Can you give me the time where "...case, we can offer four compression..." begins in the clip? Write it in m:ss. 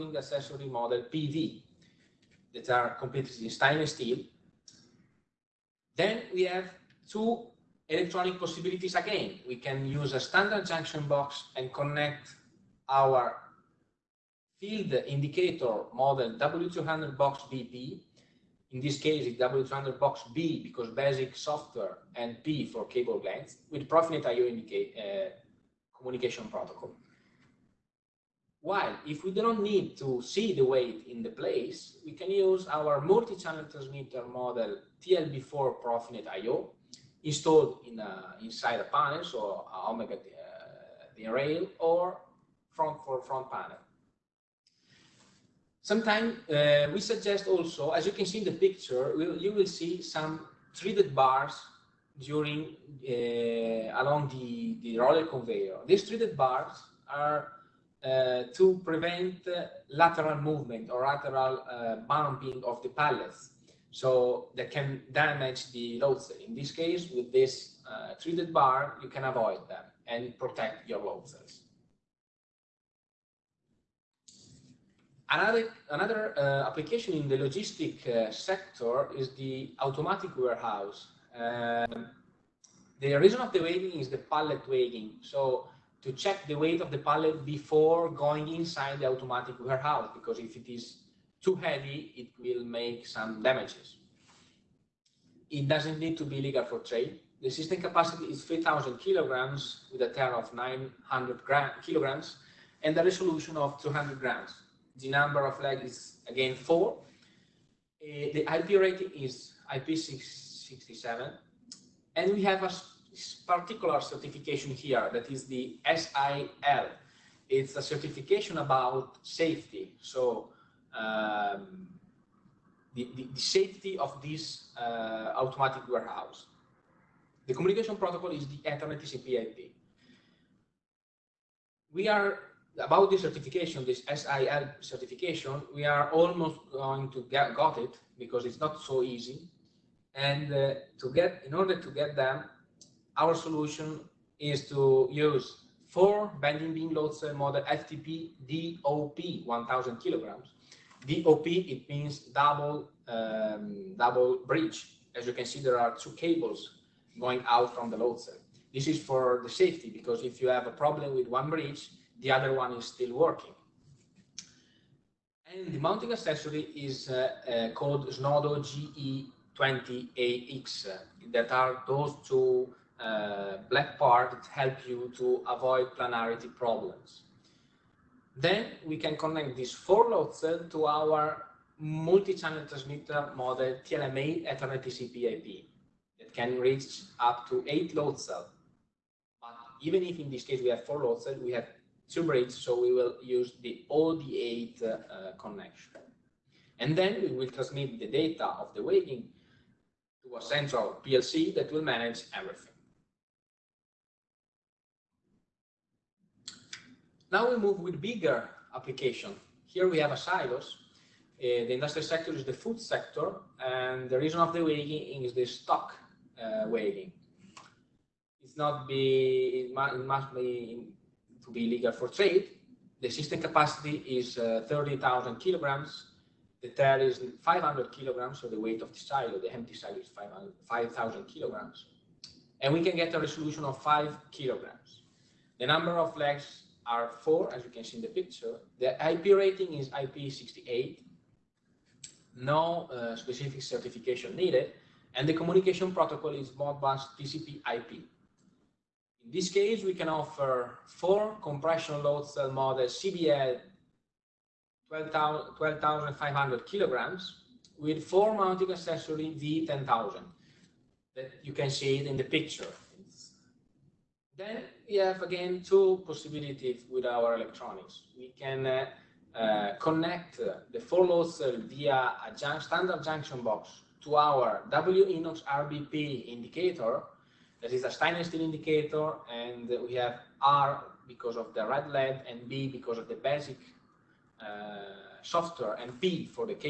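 4:09.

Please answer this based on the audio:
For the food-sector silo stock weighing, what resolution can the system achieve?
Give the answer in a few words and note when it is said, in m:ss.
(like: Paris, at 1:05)
5 kilograms, at 3:53.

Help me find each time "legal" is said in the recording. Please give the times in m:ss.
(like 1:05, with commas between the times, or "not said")
1:36, 3:41.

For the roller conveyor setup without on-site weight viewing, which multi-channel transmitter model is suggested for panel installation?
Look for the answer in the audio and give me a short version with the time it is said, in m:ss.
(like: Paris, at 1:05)
TLB4 Profinet IO, at 0:35.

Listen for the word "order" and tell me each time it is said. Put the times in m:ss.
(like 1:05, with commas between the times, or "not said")
2:21.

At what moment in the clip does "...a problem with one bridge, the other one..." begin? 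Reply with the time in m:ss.
2:40.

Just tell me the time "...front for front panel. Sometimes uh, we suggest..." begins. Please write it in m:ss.
0:42.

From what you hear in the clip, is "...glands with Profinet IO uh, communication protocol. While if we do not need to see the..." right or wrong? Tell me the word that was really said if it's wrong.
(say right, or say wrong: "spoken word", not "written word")
right.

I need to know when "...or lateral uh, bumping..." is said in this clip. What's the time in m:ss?
1:00.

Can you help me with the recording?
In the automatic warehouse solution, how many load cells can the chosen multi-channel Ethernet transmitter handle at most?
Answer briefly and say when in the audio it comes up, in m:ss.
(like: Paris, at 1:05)
8, at 3:07.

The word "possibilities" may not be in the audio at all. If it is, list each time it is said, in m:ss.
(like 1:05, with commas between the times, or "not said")
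0:08, 4:26.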